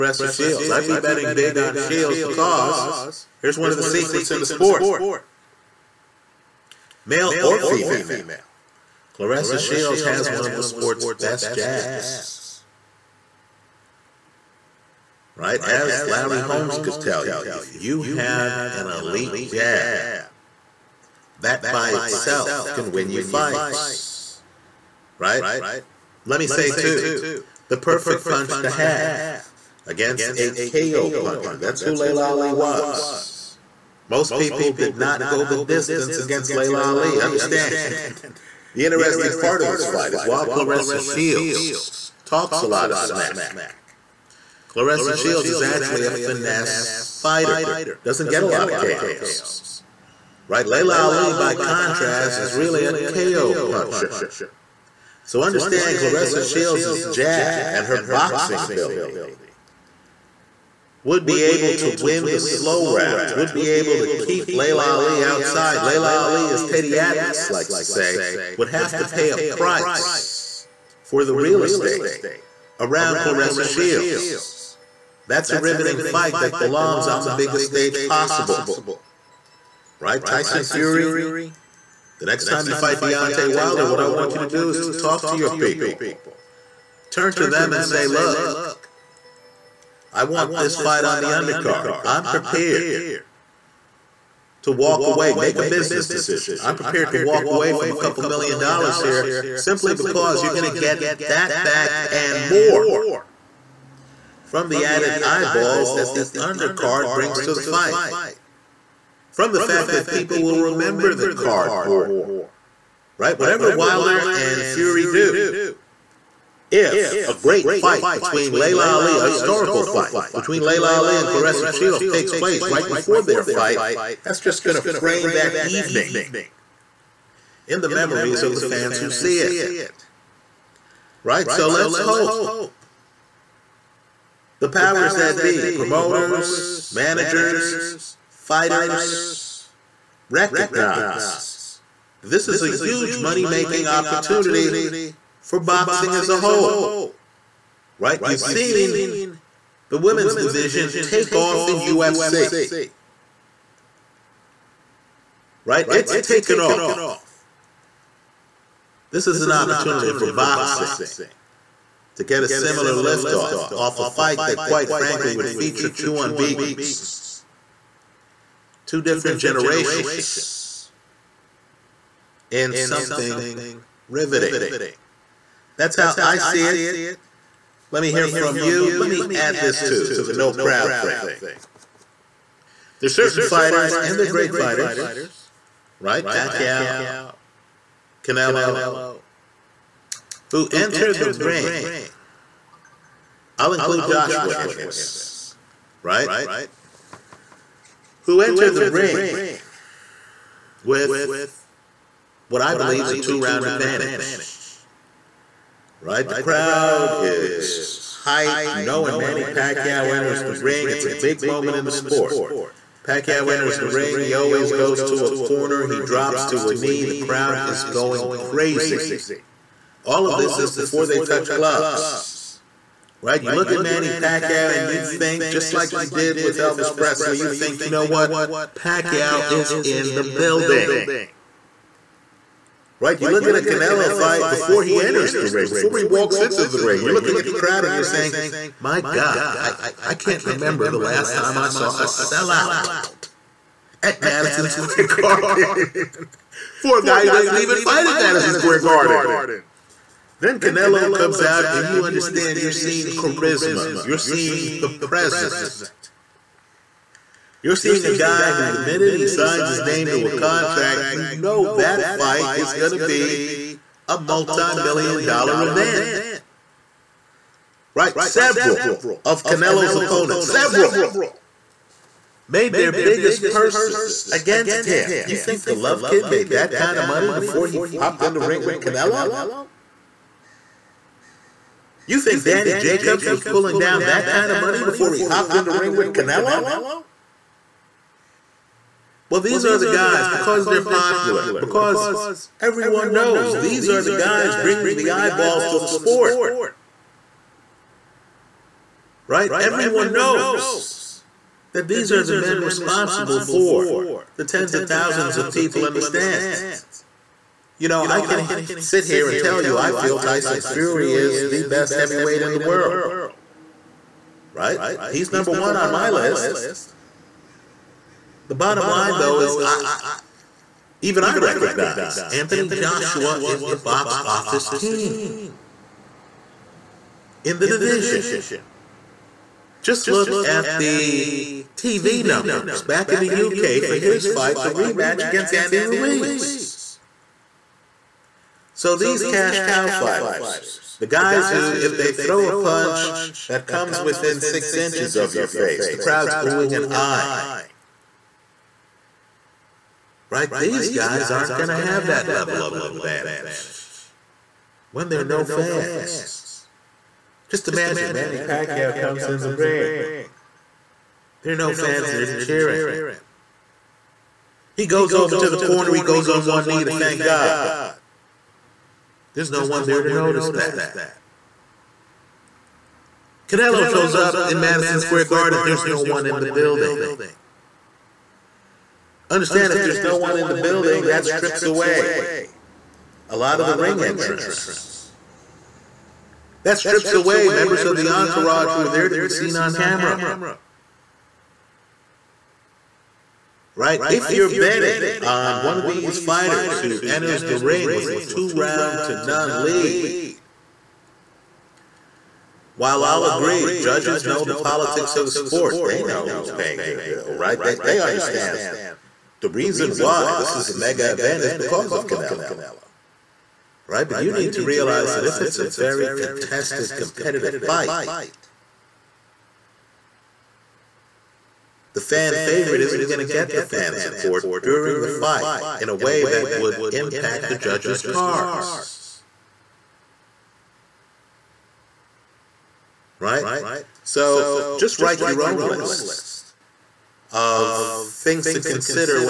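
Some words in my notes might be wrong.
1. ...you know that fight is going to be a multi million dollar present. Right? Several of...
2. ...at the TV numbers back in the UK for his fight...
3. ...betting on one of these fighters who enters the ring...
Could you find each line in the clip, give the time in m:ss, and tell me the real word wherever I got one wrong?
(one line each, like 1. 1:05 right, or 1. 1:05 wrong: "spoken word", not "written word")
1. 4:21 wrong: "event", not "present"
2. 5:30 right
3. 6:34 right.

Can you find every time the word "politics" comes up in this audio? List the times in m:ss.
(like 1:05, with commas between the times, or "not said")
6:44.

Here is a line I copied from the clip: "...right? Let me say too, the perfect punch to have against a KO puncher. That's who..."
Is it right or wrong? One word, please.
right.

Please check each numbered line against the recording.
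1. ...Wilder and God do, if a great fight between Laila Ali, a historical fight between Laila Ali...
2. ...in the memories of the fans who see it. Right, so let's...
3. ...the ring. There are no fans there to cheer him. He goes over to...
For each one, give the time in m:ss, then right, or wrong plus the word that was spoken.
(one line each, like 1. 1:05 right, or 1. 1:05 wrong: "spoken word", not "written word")
1. 1:53 wrong: "Fury", not "God"
2. 2:07 right
3. 5:59 right.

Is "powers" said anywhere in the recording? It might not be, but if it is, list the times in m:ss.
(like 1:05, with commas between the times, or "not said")
2:14.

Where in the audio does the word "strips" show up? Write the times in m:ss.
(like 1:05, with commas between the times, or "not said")
6:21, 6:26.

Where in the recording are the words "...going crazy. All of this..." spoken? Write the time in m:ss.
3:37.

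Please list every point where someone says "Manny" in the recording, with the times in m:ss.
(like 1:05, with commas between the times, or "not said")
3:29, 3:43, 5:58.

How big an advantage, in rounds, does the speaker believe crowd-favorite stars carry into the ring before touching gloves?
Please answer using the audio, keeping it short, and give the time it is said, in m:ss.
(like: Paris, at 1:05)
2 rounds, at 3:23.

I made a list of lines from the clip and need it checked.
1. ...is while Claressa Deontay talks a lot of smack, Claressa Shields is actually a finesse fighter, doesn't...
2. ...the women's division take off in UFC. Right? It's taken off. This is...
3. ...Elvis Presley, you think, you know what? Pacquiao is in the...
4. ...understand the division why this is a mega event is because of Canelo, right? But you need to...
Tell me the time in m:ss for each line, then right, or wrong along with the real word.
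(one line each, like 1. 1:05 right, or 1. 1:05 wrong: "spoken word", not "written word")
1. 0:40 wrong: "Shields", not "Deontay"
2. 2:29 right
3. 3:46 right
4. 6:48 wrong: "reason", not "division".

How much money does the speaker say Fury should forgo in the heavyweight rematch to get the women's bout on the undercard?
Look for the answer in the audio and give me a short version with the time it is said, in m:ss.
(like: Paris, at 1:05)
A couple million dollars, at 1:37.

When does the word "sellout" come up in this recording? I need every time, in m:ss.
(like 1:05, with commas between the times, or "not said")
4:02.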